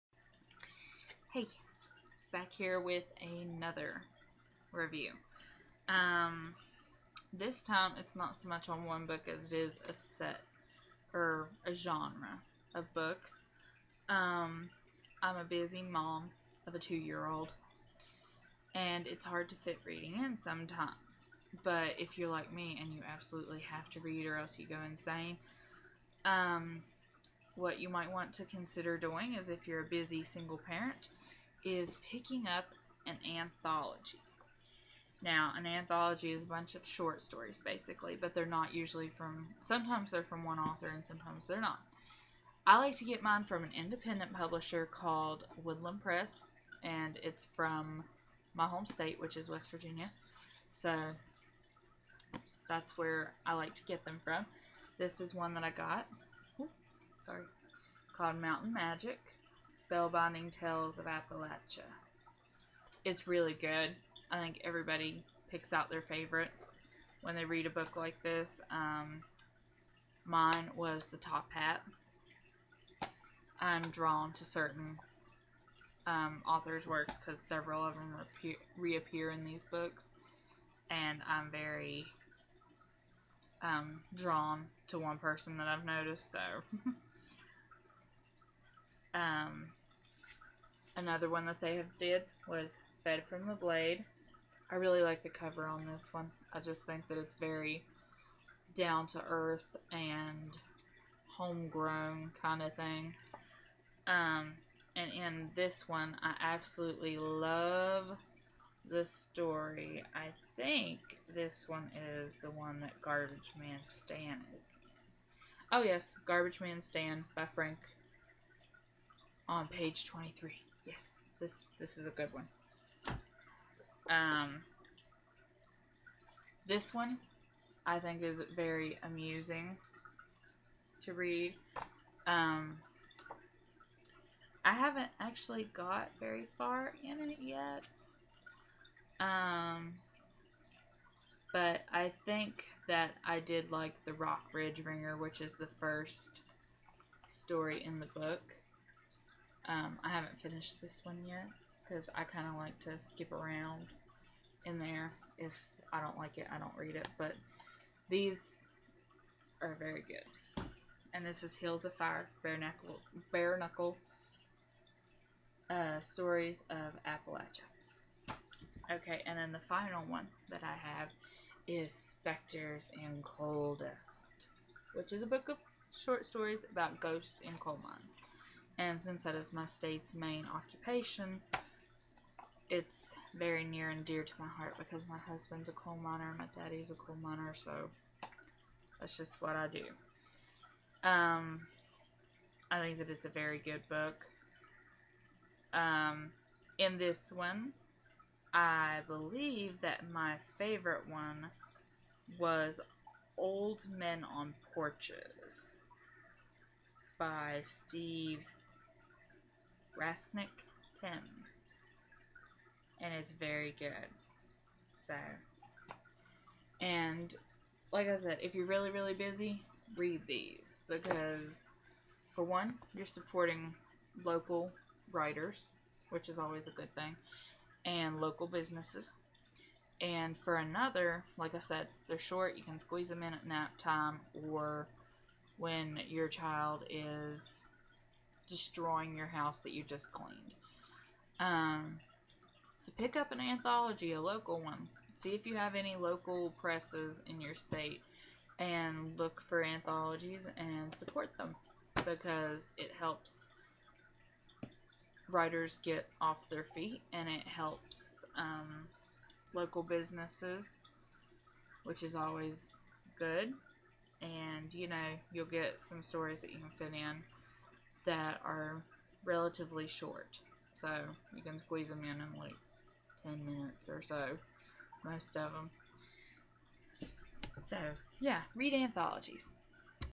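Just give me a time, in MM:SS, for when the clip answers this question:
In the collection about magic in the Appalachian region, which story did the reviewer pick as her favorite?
01:11.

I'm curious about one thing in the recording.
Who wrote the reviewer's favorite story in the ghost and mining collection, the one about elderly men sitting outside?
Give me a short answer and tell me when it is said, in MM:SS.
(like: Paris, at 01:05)
Steve Rasnic Tem, at 03:27.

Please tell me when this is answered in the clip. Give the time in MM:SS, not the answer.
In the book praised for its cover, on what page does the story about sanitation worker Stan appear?
01:59.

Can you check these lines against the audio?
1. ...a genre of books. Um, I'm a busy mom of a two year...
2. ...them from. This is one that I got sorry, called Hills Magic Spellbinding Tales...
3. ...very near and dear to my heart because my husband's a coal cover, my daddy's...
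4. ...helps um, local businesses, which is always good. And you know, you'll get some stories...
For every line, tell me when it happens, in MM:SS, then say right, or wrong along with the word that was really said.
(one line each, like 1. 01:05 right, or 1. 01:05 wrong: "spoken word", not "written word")
1. 00:11 right
2. 00:54 wrong: "Mountain", not "Hills"
3. 03:03 wrong: "miner", not "cover"
4. 04:17 right.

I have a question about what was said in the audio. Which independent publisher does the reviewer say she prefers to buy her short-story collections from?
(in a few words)
Woodland Press.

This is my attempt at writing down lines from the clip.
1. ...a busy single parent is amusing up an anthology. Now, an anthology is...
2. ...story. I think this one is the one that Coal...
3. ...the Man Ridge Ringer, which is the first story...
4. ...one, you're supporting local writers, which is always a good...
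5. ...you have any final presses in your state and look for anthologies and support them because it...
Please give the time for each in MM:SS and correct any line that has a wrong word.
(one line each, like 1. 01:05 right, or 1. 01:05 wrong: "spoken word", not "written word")
1. 00:29 wrong: "picking", not "amusing"
2. 01:49 wrong: "Garbage", not "Coal"
3. 02:24 wrong: "Rock", not "Man"
4. 03:42 right
5. 04:05 wrong: "local", not "final".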